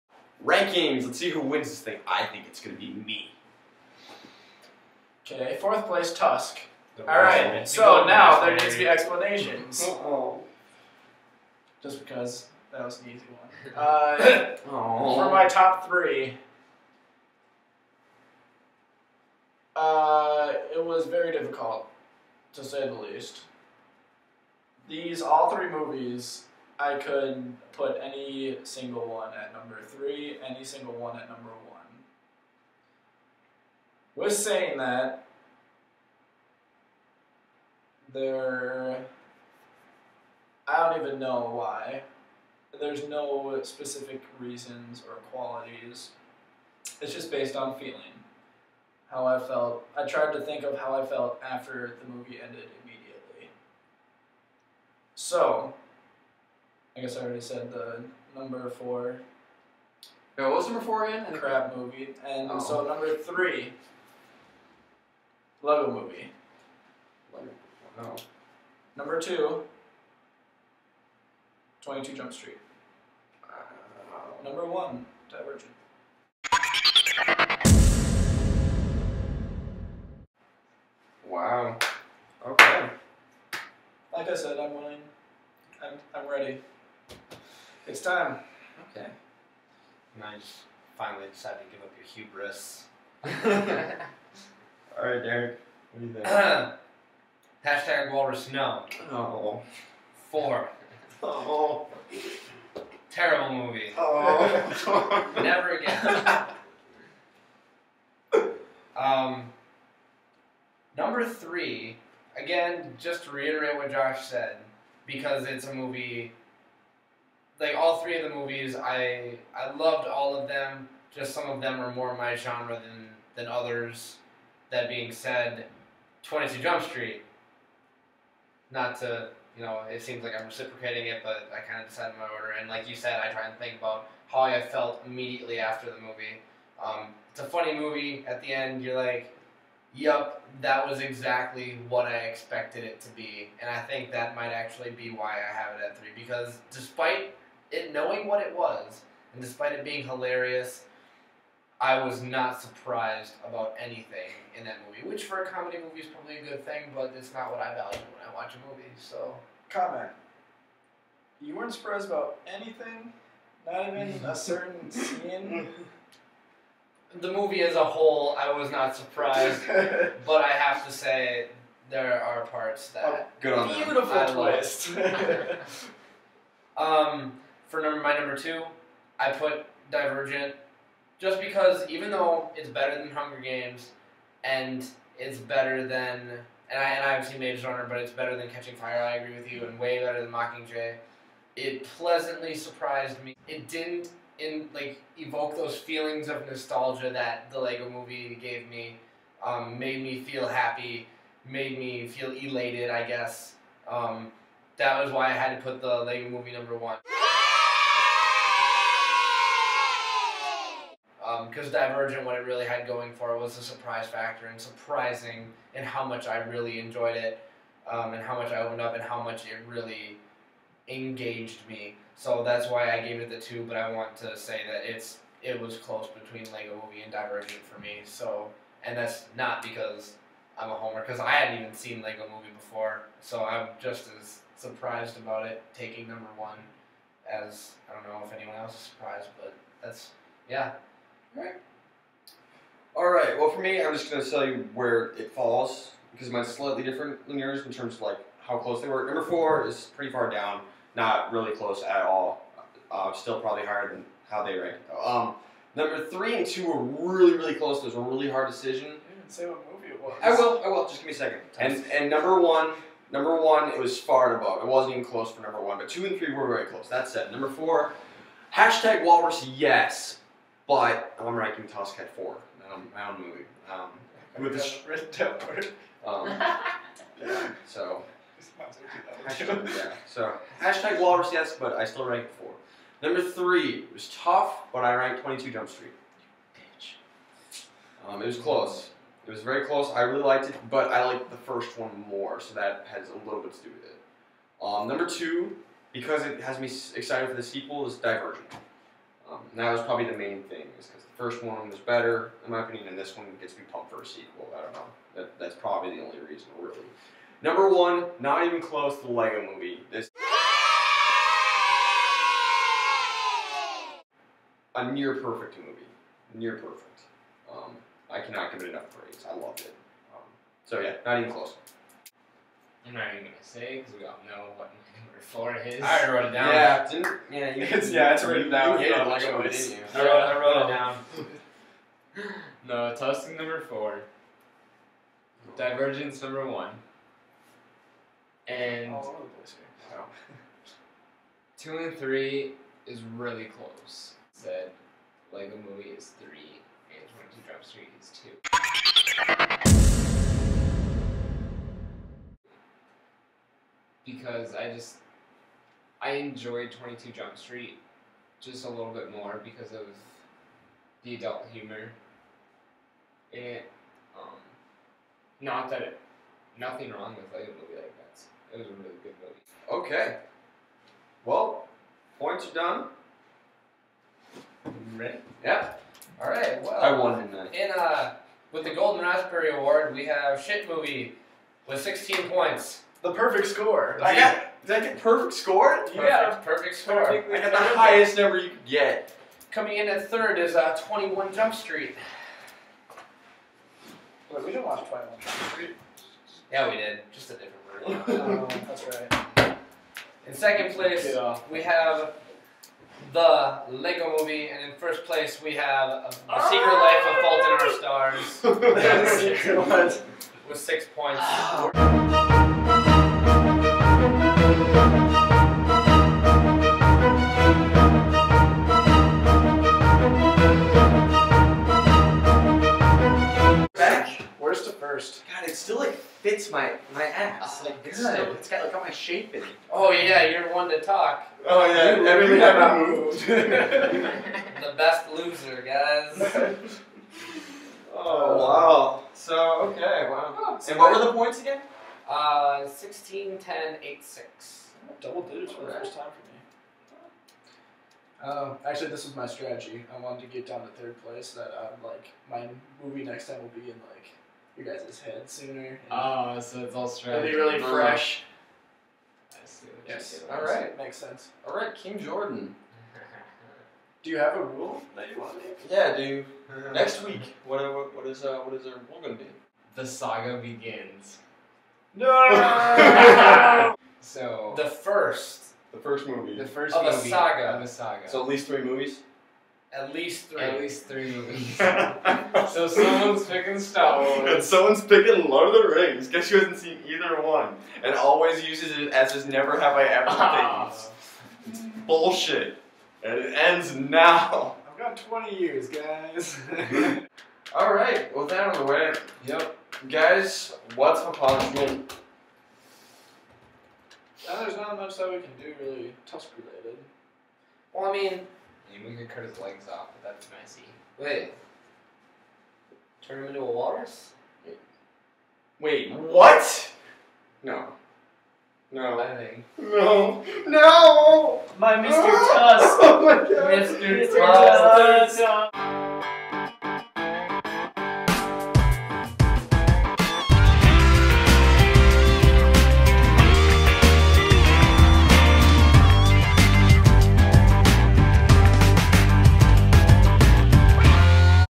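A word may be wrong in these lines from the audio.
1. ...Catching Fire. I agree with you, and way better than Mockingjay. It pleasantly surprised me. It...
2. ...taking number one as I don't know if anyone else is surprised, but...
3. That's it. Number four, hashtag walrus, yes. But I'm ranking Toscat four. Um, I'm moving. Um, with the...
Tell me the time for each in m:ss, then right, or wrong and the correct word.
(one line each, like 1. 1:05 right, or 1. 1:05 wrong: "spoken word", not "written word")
1. 3:08 right
2. 3:55 right
3. 4:26 right.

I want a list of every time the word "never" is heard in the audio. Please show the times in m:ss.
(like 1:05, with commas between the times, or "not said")
1:45, 8:09.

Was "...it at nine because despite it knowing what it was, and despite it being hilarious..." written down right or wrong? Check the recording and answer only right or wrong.
wrong.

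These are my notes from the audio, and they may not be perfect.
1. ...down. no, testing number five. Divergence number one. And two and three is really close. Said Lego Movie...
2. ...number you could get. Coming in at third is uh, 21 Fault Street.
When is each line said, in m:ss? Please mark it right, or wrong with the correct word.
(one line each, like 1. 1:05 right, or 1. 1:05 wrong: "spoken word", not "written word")
1. 5:32 wrong: "four", not "five"
2. 6:28 wrong: "Jump", not "Fault".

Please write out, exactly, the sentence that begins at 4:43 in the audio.
Number three was tough, but I ranked 22 Jump Street.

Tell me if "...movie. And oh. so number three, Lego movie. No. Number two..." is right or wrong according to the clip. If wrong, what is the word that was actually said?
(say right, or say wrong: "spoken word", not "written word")
right.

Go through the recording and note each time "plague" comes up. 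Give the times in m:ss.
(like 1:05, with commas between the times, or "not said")
not said.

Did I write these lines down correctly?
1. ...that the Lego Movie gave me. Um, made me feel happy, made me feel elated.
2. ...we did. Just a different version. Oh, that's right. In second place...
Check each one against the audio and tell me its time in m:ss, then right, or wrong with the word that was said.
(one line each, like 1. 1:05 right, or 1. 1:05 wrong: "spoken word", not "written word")
1. 3:17 right
2. 6:36 right.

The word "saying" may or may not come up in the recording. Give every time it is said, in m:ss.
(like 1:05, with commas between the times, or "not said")
0:34.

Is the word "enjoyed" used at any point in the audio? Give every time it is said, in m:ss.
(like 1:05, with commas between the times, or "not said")
3:36, 5:56.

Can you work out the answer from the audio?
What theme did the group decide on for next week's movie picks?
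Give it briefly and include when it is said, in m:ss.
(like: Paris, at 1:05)
The saga begins, at 7:49.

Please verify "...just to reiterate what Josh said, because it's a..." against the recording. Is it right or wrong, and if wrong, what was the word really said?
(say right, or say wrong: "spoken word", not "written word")
right.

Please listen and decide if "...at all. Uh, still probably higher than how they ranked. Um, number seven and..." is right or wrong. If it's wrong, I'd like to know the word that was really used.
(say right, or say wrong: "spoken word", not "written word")
wrong: "three", not "seven".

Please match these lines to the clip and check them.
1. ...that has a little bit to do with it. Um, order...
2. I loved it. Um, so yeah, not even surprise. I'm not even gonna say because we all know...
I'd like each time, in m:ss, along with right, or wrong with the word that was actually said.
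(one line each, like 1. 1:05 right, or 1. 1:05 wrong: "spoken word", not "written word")
1. 4:52 wrong: "number", not "order"
2. 5:19 wrong: "close", not "surprise".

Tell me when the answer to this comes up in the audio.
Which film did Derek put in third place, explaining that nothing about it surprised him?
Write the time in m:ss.
2:06.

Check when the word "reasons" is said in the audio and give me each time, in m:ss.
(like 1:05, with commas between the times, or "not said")
0:44, 5:06.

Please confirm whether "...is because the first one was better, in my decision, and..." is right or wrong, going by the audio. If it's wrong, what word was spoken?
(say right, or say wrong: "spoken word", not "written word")
wrong: "opinion", not "decision".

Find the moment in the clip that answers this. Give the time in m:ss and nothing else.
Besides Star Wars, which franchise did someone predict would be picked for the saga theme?
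8:05.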